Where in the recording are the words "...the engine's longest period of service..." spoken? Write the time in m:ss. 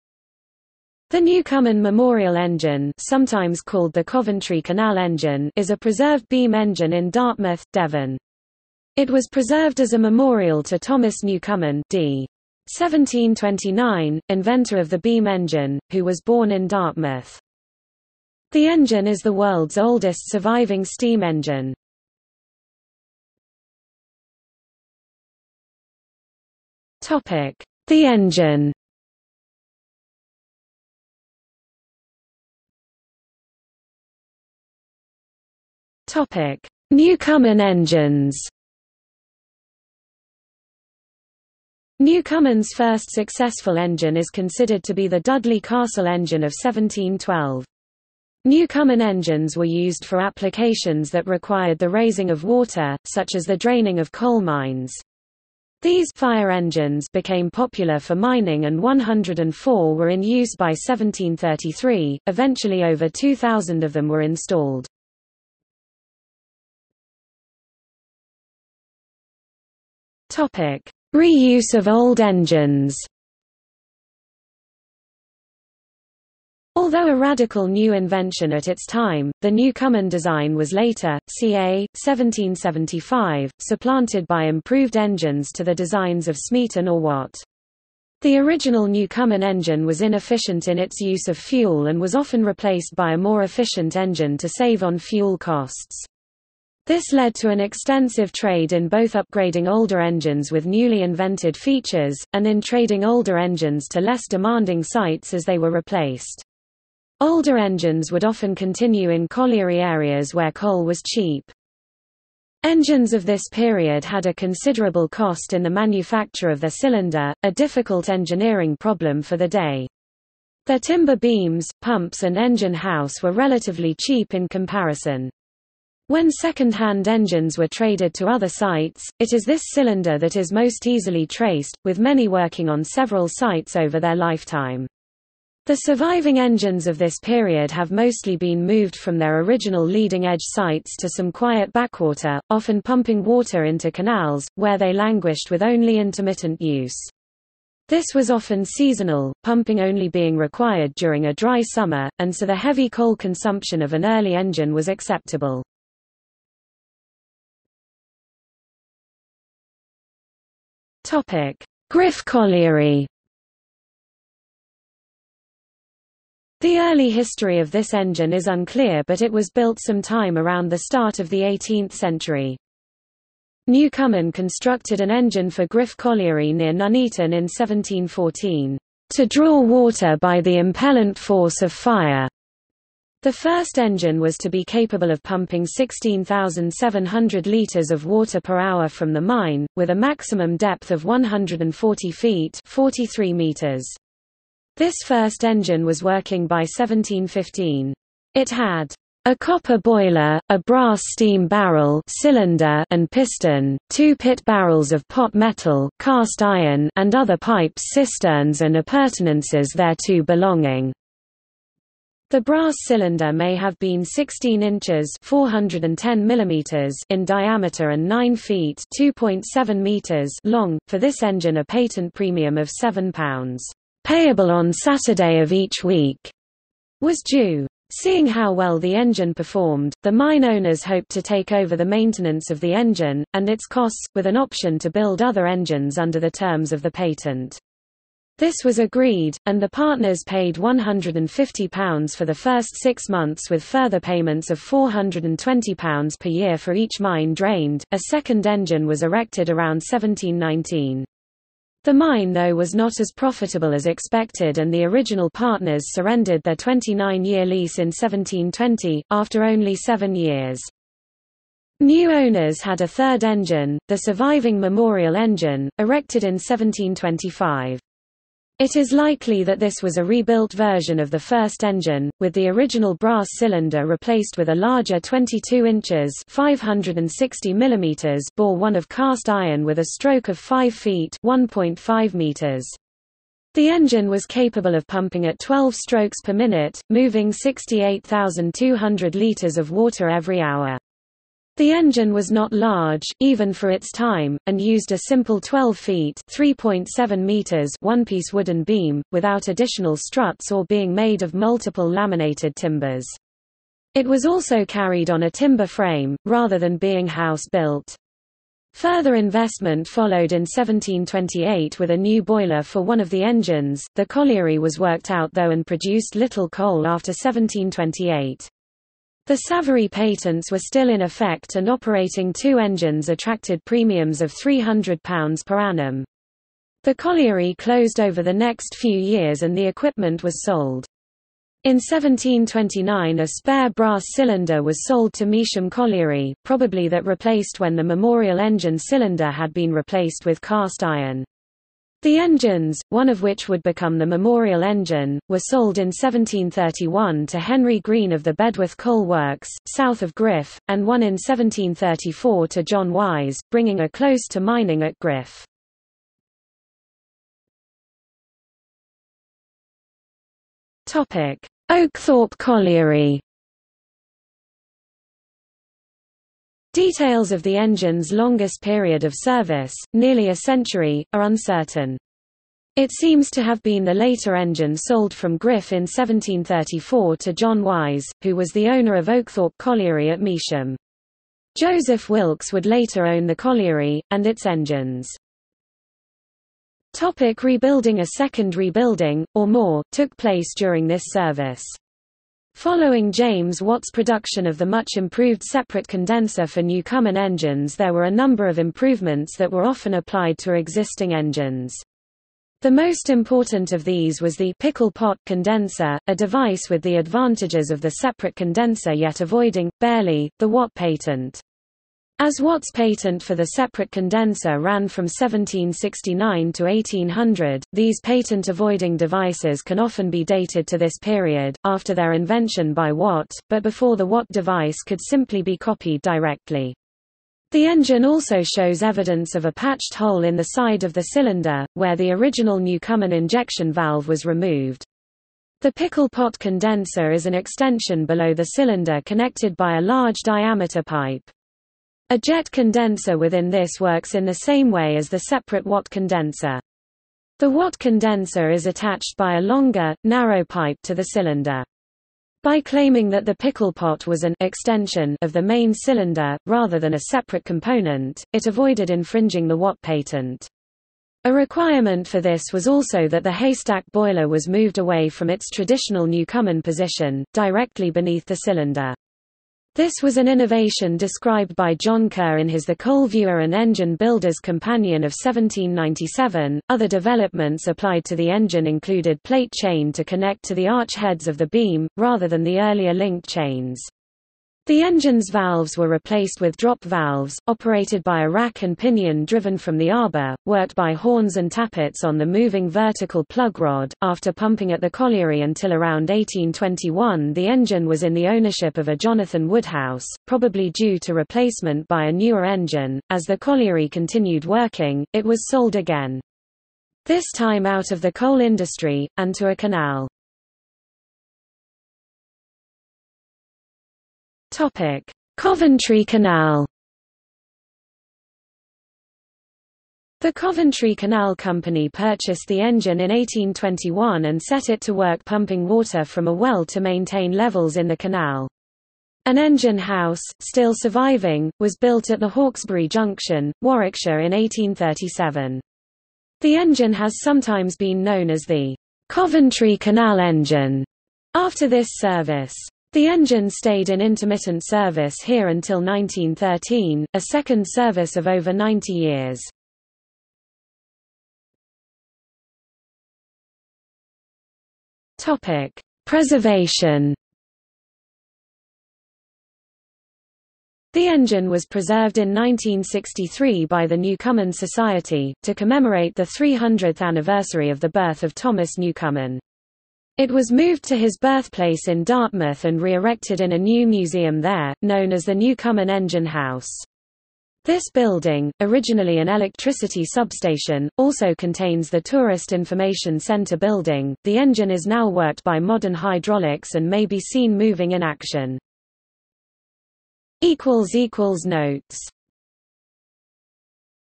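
6:07.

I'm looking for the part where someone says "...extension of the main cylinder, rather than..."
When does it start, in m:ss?
7:34.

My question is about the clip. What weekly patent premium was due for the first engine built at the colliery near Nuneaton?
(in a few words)
£7.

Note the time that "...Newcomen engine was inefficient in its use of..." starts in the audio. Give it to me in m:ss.
1:28.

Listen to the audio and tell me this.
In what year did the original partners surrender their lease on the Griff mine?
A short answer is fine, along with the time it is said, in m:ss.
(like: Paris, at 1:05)
1720, at 4:17.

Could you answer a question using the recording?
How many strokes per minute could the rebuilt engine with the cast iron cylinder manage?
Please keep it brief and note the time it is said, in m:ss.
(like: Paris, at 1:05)
12, at 4:45.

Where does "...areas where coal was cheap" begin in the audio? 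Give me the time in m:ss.
1:49.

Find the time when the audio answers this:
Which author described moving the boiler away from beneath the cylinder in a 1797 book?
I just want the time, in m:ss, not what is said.
7:51.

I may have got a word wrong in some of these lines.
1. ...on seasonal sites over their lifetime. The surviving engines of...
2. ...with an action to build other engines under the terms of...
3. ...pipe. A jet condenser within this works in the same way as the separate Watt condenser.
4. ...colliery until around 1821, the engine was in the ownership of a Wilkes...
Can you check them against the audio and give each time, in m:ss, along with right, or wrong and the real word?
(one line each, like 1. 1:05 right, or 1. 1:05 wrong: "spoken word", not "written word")
1. 2:12 wrong: "several", not "seasonal"
2. 3:54 wrong: "option", not "action"
3. 7:20 right
4. 8:14 wrong: "Jonathan", not "Wilkes".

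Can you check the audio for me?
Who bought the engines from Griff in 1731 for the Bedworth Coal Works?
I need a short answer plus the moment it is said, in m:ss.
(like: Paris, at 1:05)
Henry Green, at 5:47.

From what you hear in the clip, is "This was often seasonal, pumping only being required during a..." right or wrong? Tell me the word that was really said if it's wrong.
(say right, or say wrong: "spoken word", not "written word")
right.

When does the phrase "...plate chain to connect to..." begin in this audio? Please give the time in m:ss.
7:59.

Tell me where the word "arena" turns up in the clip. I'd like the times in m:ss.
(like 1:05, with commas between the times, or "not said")
not said.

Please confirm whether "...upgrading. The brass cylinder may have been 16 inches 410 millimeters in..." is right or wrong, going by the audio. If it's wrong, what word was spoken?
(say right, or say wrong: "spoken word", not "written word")
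wrong: "belonging", not "upgrading".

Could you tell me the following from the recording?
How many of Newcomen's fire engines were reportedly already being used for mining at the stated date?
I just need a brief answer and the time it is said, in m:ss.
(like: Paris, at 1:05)
104, at 0:58.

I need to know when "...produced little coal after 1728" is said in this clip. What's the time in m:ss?
5:15.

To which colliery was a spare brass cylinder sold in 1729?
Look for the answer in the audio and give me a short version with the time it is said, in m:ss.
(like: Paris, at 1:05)
Measham Colliery, at 5:35.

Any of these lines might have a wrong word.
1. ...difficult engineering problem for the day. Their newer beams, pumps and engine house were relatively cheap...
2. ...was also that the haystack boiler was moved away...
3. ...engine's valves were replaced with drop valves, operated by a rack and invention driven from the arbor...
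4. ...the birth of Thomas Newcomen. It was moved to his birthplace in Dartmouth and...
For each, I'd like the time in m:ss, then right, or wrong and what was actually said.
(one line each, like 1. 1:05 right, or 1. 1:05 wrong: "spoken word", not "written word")
1. 1:57 wrong: "timber", not "newer"
2. 7:42 right
3. 8:04 wrong: "pinion", not "invention"
4. 9:27 right.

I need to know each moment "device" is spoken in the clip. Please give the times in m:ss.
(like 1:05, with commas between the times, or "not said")
6:46, 6:58, 7:04.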